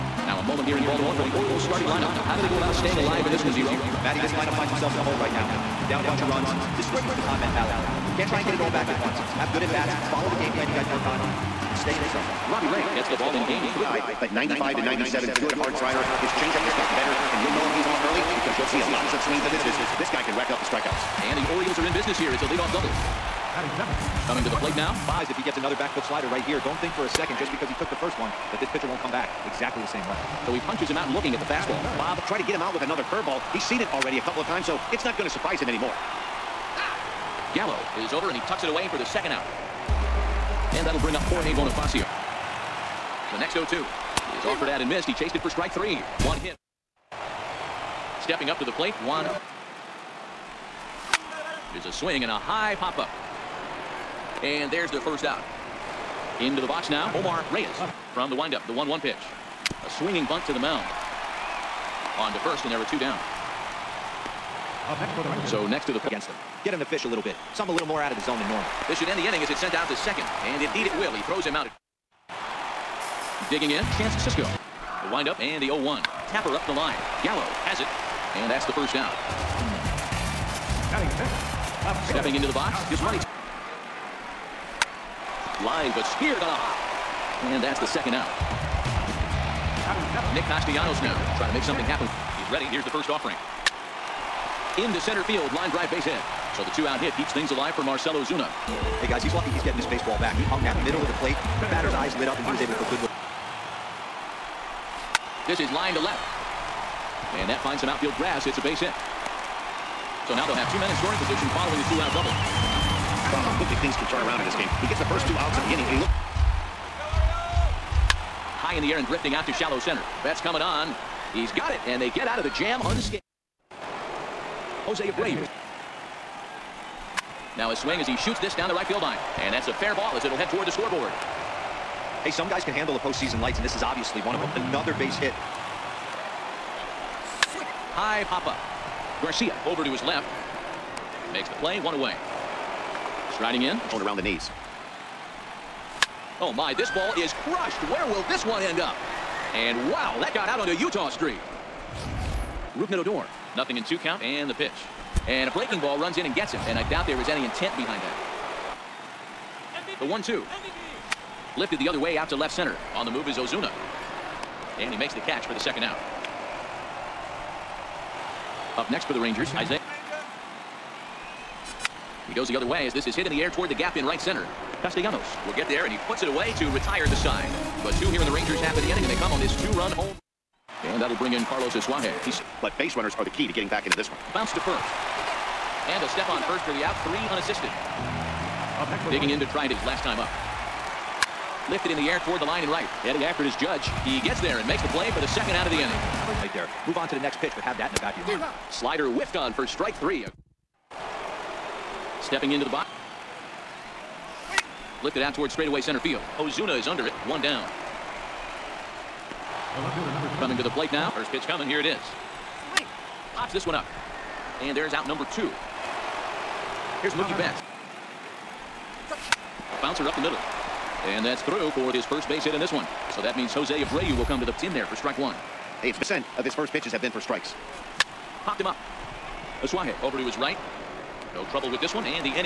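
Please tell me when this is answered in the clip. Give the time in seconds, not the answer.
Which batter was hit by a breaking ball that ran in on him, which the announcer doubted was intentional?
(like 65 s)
152 s.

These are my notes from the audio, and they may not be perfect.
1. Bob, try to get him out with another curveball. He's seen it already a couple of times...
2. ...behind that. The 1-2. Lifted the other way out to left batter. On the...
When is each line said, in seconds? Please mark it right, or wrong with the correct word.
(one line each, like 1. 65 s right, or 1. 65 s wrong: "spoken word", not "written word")
1. 31 s right
2. 157 s wrong: "center", not "batter".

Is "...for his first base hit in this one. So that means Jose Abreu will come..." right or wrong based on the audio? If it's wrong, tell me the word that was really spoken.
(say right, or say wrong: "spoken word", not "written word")
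right.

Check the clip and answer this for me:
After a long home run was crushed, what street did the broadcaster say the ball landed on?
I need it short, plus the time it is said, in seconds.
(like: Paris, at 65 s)
Utah Street, at 150 s.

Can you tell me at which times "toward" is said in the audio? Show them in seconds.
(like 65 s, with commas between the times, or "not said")
130 s, 173 s, 192 s, 205 s.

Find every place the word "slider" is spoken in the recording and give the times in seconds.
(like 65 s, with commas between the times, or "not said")
15 s, 26 s, 198 s.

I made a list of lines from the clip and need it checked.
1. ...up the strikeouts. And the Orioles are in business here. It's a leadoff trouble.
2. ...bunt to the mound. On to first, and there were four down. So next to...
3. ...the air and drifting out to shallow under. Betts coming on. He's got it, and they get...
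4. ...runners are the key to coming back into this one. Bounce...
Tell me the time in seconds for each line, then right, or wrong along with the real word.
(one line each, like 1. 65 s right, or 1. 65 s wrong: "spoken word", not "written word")
1. 20 s wrong: "double", not "trouble"
2. 60 s wrong: "two", not "four"
3. 118 s wrong: "center", not "under"
4. 182 s wrong: "getting", not "coming".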